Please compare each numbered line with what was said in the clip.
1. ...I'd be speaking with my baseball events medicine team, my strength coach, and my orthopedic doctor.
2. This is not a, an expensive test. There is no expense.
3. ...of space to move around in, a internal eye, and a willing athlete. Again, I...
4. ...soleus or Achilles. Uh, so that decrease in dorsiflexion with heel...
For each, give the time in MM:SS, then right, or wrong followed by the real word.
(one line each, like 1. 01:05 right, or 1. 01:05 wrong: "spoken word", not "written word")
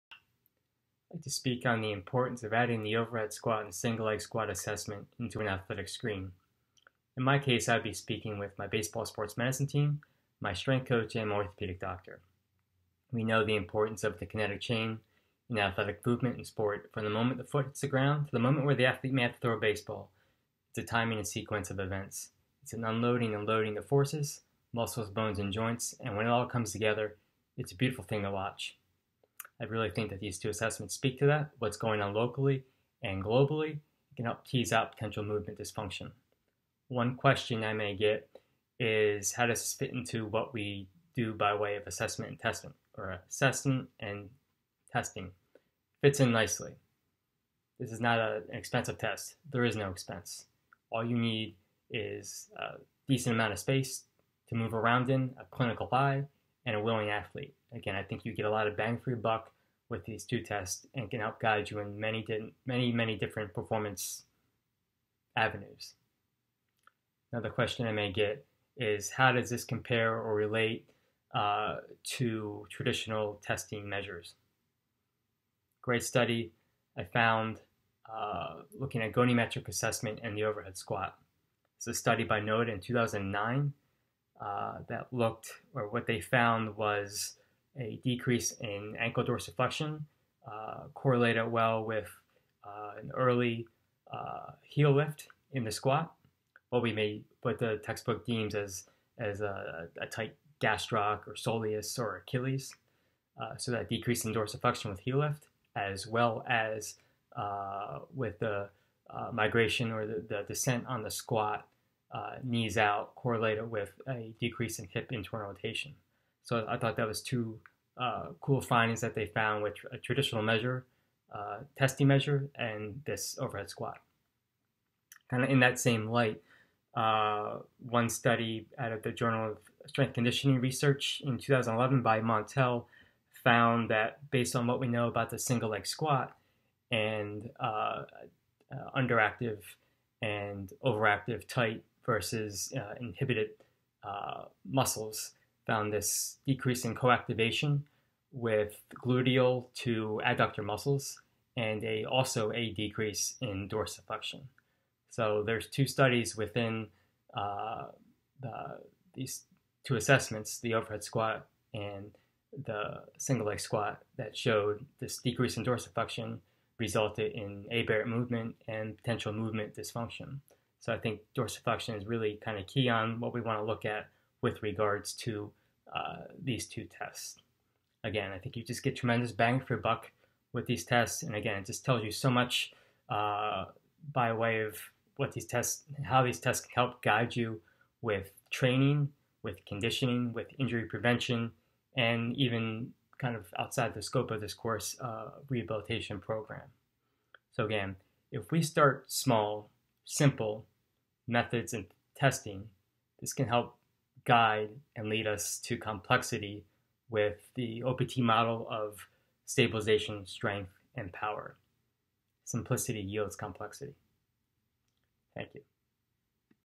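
1. 00:07 wrong: "sports", not "events"
2. 00:47 right
3. 00:53 wrong: "clinical", not "internal"
4. 01:41 right.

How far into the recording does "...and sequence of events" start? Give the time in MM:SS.
00:21.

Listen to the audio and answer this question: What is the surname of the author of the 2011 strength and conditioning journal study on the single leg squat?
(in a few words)
Mauntel.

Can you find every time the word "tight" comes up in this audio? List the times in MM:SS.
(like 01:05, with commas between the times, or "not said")
01:40, 02:21.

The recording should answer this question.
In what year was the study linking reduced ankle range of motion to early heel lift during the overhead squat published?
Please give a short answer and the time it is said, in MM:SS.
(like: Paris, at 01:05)
2009, at 01:22.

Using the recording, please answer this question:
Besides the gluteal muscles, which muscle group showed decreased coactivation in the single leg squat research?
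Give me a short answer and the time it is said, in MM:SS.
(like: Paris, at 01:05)
Adductor, at 02:30.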